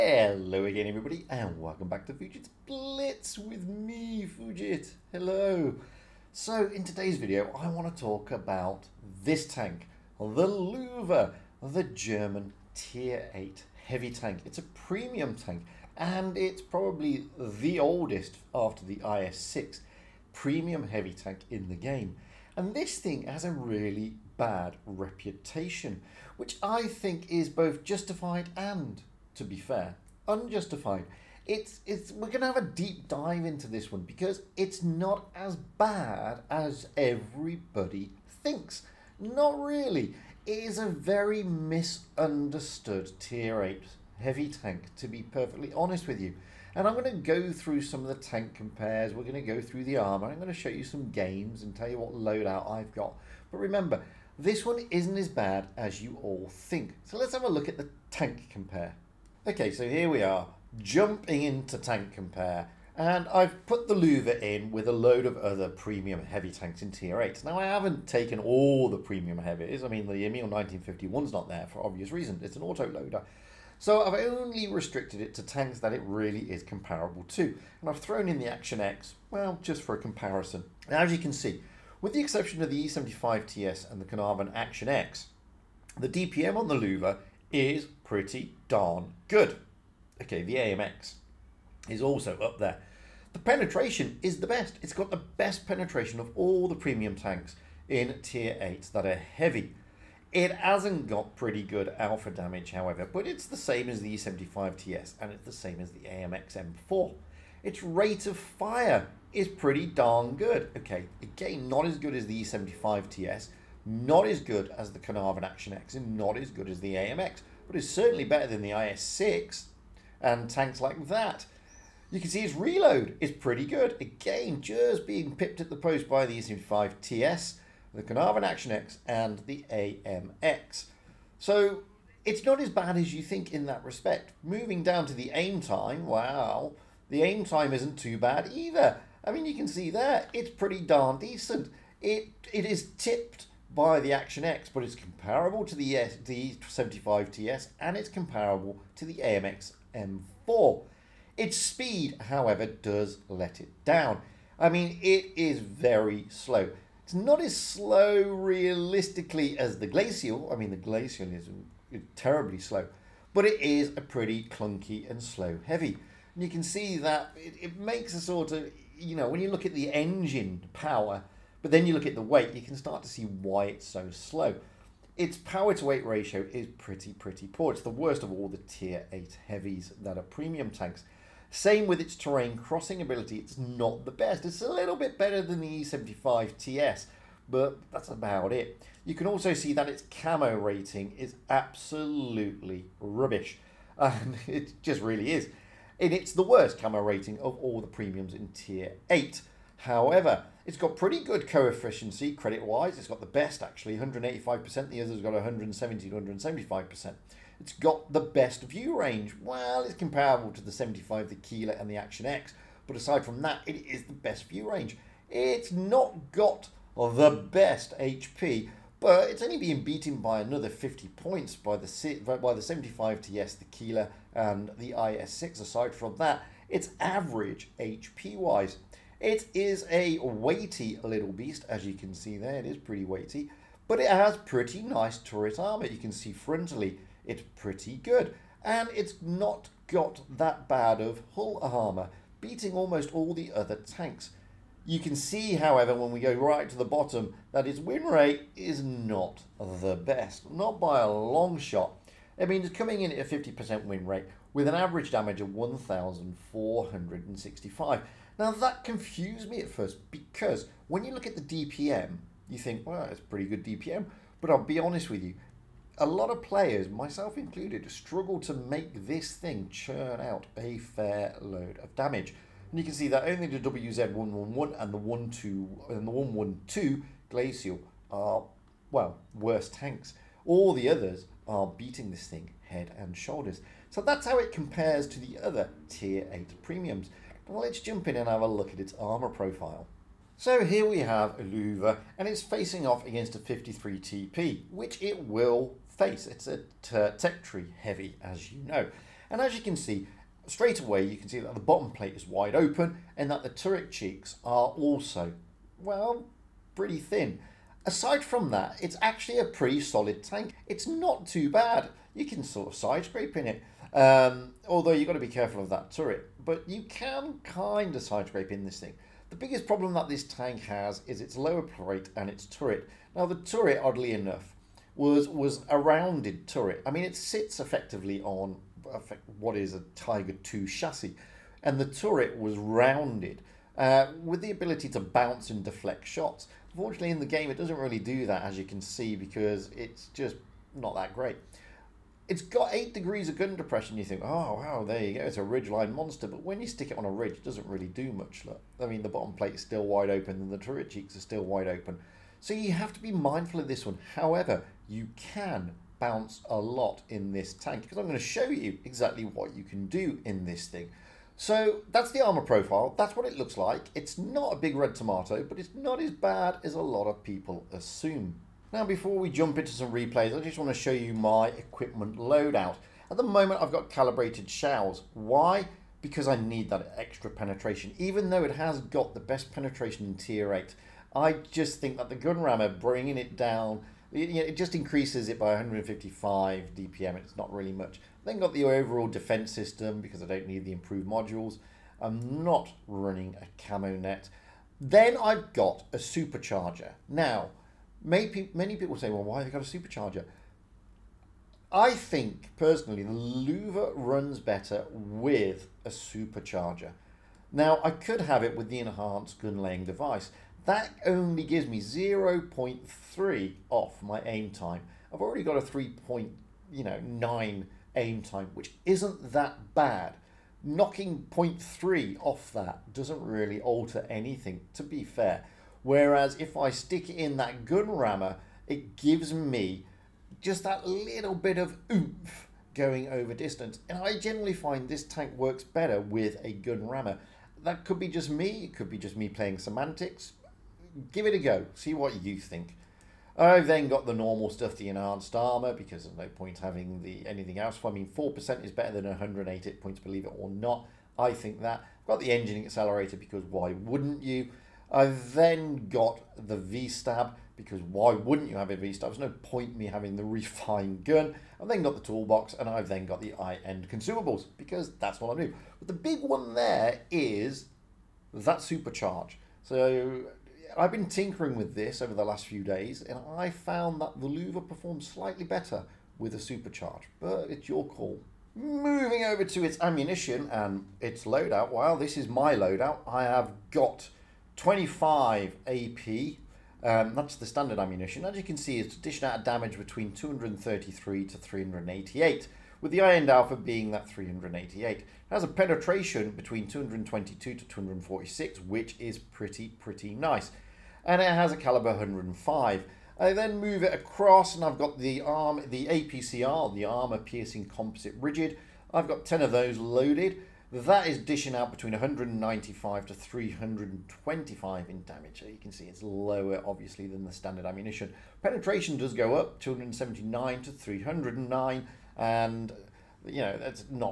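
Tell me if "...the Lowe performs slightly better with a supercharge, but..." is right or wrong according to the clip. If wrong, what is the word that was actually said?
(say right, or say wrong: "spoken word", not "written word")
right.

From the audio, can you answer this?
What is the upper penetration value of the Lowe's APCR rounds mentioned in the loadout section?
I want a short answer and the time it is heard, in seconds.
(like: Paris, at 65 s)
309, at 520 s.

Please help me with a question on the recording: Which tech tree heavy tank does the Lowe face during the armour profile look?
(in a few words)
53 TP.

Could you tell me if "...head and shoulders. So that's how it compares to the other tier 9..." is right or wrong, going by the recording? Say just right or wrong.
wrong.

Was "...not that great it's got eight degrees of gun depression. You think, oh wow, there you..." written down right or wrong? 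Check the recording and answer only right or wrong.
right.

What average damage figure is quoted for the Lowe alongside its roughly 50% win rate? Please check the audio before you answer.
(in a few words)
1,465.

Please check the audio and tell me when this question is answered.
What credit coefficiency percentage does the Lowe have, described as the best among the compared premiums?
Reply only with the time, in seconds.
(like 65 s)
203 s.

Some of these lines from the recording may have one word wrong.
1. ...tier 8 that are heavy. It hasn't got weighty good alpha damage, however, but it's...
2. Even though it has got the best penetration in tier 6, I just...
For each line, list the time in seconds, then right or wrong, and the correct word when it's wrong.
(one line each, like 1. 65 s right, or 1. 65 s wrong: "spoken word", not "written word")
1. 98 s wrong: "pretty", not "weighty"
2. 377 s wrong: "8", not "6".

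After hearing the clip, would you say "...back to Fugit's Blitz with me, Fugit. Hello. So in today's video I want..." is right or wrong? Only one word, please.
right.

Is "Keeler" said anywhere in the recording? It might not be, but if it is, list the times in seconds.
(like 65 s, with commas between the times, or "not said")
211 s, 223 s.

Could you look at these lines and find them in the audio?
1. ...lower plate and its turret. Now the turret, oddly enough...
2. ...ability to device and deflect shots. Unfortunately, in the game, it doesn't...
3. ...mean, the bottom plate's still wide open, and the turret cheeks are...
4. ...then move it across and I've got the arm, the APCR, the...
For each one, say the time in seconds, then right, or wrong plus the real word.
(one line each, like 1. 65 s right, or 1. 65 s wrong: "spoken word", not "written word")
1. 321 s right
2. 334 s wrong: "bounce", not "device"
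3. 348 s right
4. 503 s right.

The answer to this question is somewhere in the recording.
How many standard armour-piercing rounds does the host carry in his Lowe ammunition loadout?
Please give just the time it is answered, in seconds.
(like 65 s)
484 s.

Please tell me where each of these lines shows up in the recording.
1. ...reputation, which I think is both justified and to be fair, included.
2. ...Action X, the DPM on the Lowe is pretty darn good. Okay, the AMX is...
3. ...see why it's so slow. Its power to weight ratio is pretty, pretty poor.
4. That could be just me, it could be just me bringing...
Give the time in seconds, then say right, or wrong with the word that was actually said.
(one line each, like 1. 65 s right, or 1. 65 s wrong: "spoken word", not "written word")
1. 24 s wrong: "unjustified", not "included"
2. 84 s right
3. 173 s right
4. 437 s wrong: "playing", not "bringing".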